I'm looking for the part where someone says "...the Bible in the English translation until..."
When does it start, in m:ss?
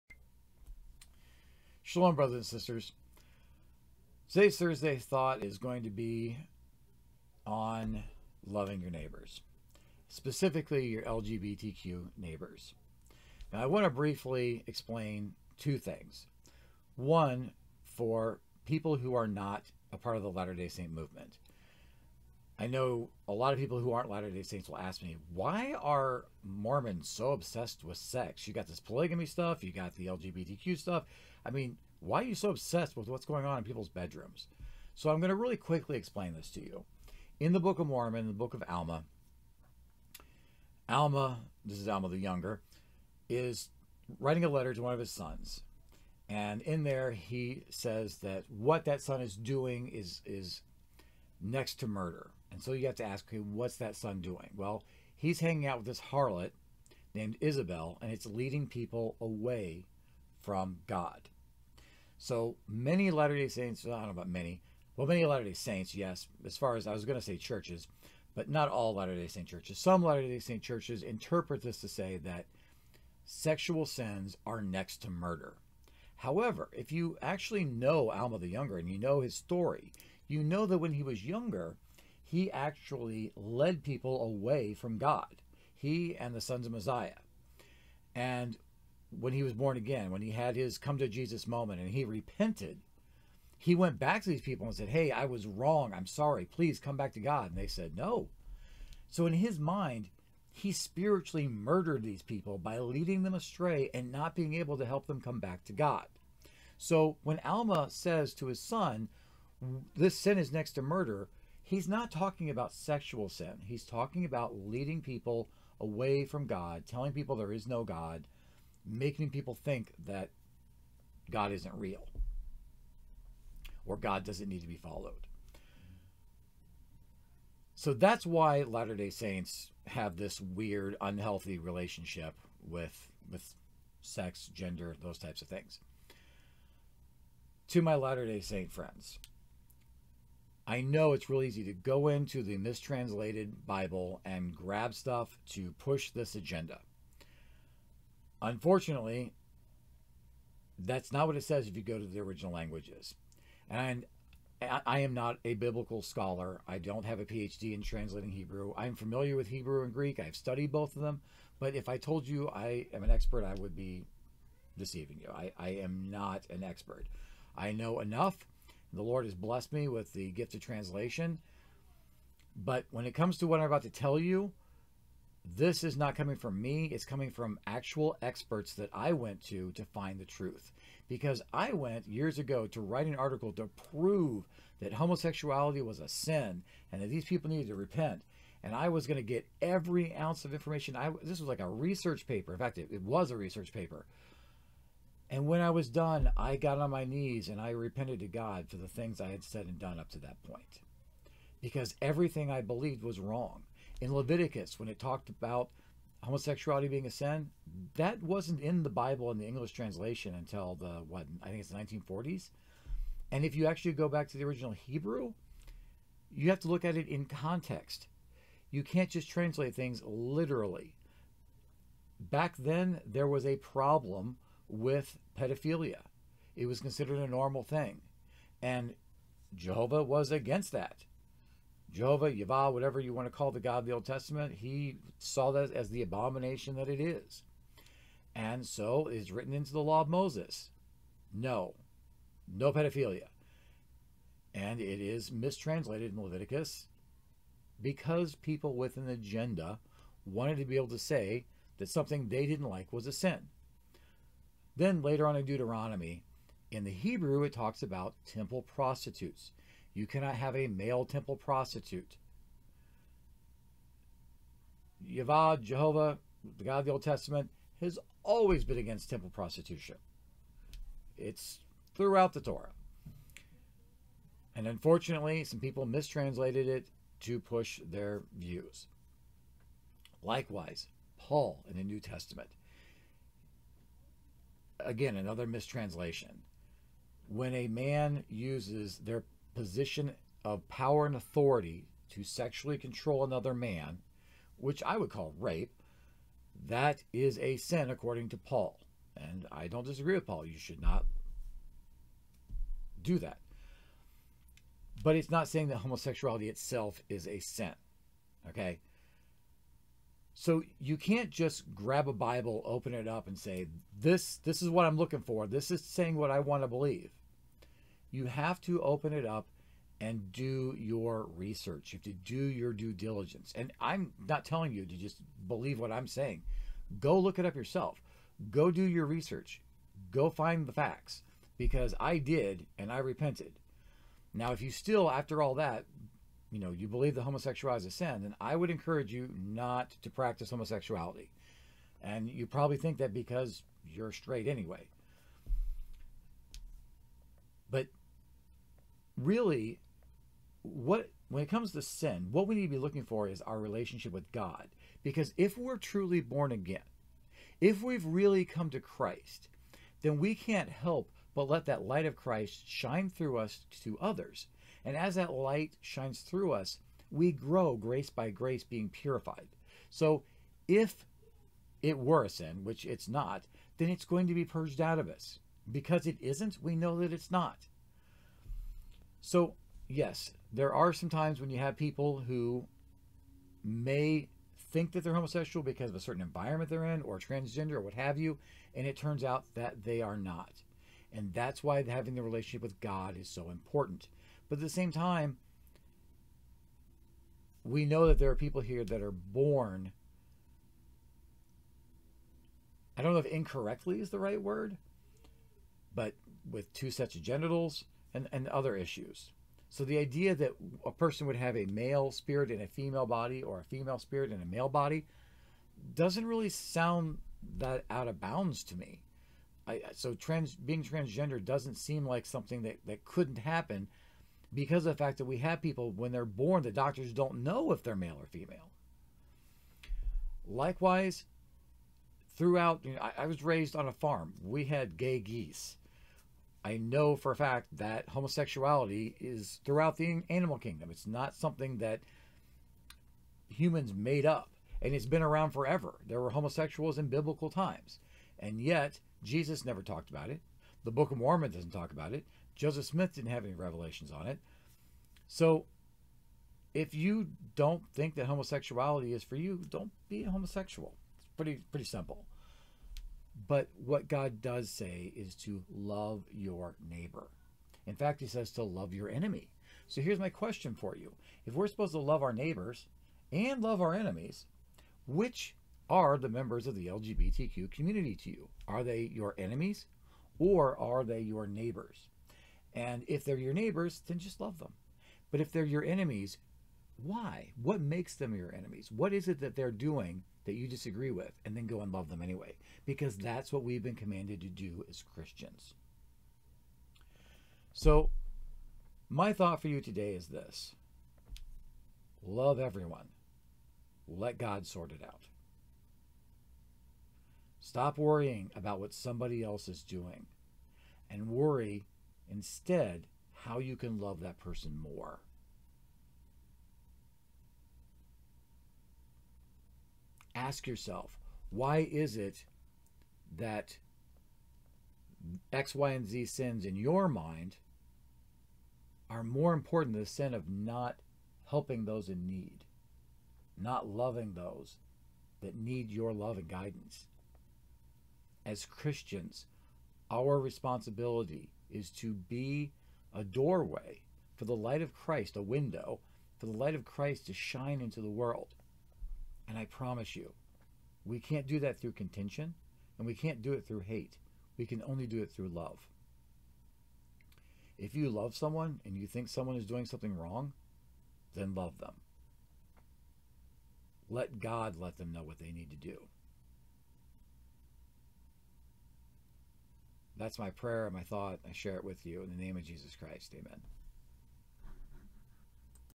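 3:28.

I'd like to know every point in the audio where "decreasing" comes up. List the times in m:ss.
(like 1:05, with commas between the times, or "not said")
not said.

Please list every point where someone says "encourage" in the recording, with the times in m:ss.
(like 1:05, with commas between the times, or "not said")
5:38.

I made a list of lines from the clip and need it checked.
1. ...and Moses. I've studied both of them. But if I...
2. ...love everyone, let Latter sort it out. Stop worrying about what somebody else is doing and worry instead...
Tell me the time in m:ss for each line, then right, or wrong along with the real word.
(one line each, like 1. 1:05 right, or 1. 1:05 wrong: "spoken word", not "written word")
1. 2:39 wrong: "Greek", not "Moses"
2. 8:22 wrong: "God", not "Latter".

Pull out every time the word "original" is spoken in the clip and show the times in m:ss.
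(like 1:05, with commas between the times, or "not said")
2:32, 3:34.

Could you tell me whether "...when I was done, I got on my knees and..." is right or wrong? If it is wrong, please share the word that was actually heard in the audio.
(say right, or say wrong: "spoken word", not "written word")
right.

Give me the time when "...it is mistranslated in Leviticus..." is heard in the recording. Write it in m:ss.
4:04.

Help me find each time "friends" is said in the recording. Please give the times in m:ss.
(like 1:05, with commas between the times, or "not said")
2:18.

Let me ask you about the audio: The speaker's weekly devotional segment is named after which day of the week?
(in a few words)
Thursday.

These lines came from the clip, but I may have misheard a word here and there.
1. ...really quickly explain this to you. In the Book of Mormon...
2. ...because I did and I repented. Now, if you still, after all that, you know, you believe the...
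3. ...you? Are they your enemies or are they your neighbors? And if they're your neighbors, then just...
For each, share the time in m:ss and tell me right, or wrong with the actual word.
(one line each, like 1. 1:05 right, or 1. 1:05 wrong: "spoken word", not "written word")
1. 0:35 right
2. 5:31 right
3. 7:58 right.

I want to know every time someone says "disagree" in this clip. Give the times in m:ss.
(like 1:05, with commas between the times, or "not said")
4:59, 8:10.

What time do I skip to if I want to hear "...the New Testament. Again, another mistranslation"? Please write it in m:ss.
4:41.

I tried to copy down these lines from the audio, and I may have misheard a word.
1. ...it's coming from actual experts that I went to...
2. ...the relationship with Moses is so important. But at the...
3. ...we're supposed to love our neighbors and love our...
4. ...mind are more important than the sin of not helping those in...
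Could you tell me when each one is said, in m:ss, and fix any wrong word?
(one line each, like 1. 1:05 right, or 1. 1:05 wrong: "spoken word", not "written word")
1. 2:56 right
2. 6:32 wrong: "God", not "Moses"
3. 7:51 right
4. 8:47 right.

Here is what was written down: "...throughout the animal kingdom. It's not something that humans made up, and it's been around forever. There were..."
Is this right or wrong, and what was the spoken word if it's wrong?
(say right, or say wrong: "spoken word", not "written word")
right.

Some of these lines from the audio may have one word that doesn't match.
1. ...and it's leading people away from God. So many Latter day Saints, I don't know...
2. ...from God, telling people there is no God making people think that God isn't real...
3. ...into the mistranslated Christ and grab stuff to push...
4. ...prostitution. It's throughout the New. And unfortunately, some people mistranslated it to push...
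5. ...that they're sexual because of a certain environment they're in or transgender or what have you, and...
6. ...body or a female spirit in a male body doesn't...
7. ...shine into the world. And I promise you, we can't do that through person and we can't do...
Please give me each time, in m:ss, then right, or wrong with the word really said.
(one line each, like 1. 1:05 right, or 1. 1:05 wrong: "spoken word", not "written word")
1. 0:58 right
2. 1:56 right
3. 2:22 wrong: "Bible", not "Christ"
4. 4:29 wrong: "Torah", not "New"
5. 6:24 wrong: "homosexual", not "sexual"
6. 6:53 right
7. 9:07 wrong: "contention", not "person".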